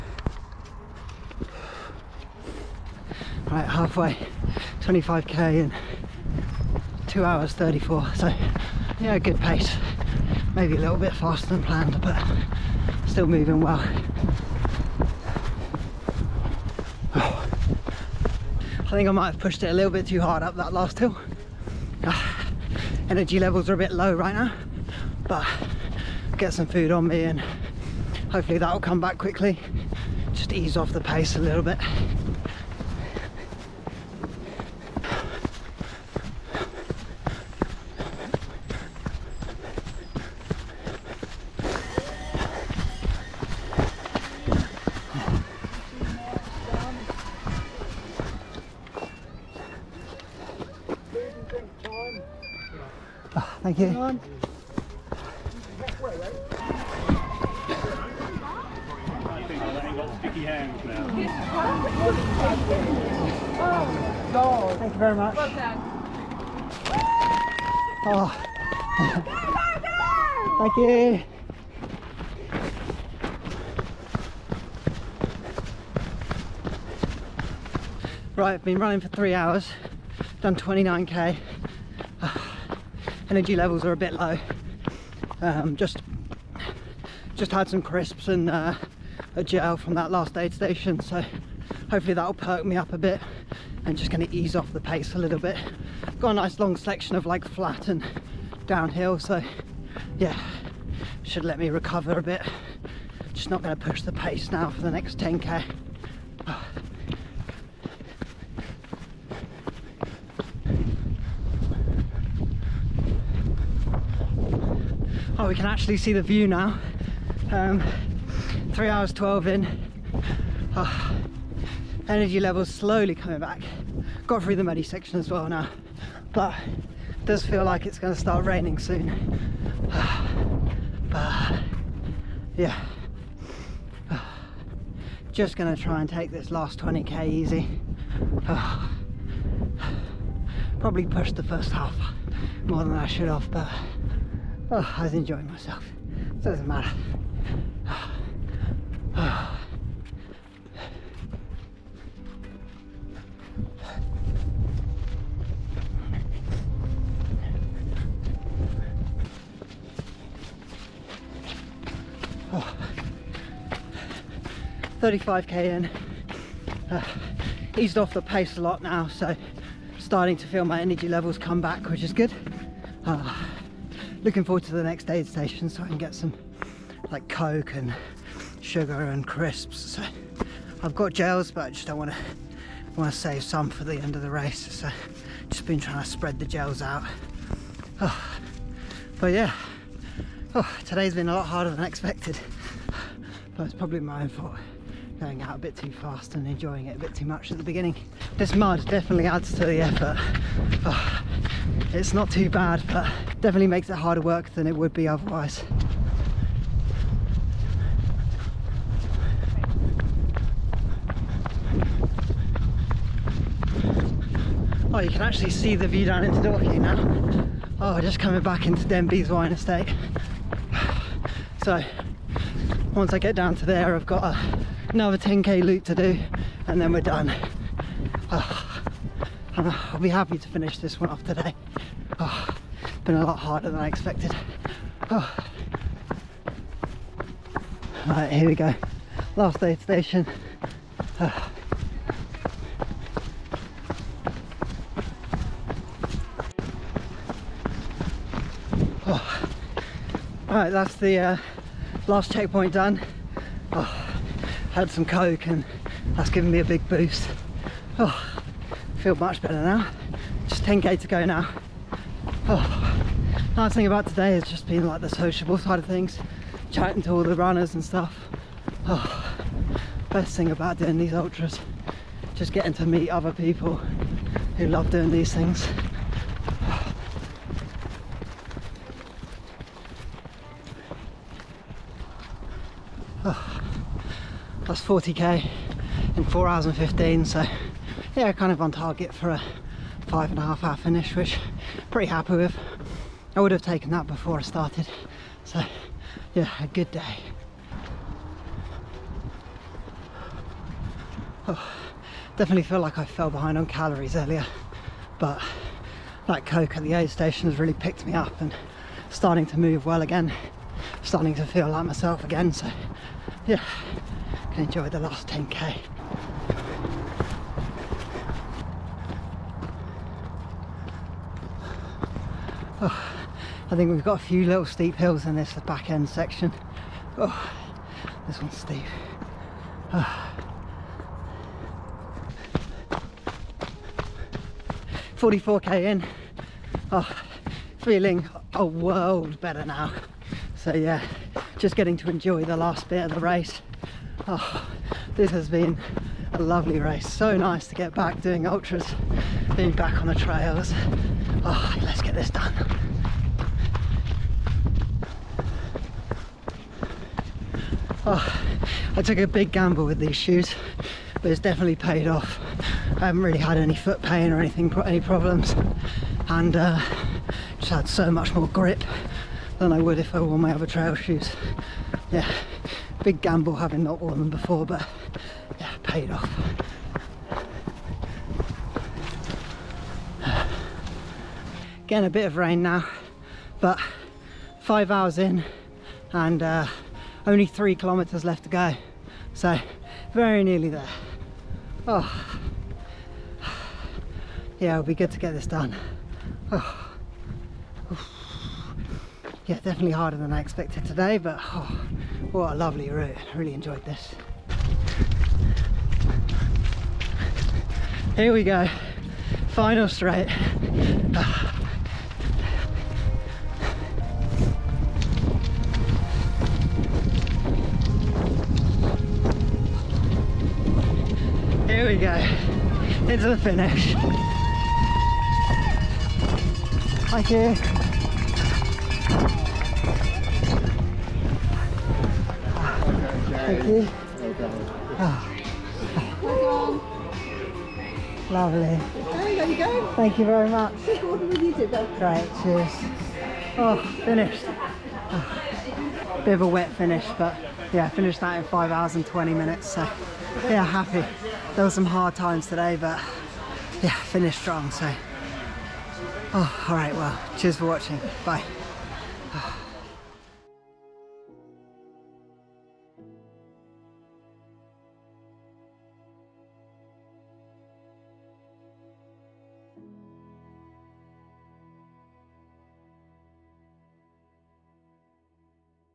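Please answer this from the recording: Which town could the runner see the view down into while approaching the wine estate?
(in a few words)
Dorking.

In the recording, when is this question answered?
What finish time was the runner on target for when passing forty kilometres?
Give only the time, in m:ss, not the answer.
4:50.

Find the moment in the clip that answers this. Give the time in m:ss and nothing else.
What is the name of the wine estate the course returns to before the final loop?
3:38.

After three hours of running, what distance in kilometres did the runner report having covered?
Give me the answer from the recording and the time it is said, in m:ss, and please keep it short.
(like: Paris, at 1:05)
29k, at 1:20.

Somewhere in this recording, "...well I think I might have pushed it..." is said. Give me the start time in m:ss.
0:13.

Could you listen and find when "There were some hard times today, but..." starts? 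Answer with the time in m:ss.
7:31.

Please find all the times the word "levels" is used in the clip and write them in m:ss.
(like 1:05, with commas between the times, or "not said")
0:23, 1:23, 2:02, 2:51.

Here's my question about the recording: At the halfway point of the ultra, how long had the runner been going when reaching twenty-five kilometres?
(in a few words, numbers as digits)
2 hours 34.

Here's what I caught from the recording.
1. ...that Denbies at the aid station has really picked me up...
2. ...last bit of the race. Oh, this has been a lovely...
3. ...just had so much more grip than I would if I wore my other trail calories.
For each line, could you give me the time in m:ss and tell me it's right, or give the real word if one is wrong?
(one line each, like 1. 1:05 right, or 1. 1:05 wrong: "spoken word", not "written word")
1. 5:06 wrong: "Coke", not "Denbies"
2. 5:42 right
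3. 6:07 wrong: "shoes", not "calories".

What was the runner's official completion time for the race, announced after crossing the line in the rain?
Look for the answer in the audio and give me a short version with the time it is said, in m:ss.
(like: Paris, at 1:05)
5 hours 20 minutes, at 7:28.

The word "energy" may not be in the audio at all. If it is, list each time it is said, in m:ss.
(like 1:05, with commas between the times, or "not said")
0:23, 1:23, 2:02, 2:50.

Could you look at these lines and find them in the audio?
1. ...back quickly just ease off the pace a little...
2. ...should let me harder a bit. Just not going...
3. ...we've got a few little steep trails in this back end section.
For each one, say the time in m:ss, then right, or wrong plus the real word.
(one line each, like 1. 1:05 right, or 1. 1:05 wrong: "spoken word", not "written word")
1. 0:28 right
2. 1:41 wrong: "recover", not "harder"
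3. 5:23 wrong: "hills", not "trails".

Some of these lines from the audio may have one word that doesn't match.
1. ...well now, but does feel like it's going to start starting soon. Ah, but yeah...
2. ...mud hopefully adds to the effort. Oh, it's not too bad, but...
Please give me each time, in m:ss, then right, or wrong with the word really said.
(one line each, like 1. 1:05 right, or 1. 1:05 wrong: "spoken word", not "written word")
1. 2:05 wrong: "raining", not "starting"
2. 3:18 wrong: "definitely", not "hopefully".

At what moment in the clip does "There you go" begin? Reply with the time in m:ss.
7:19.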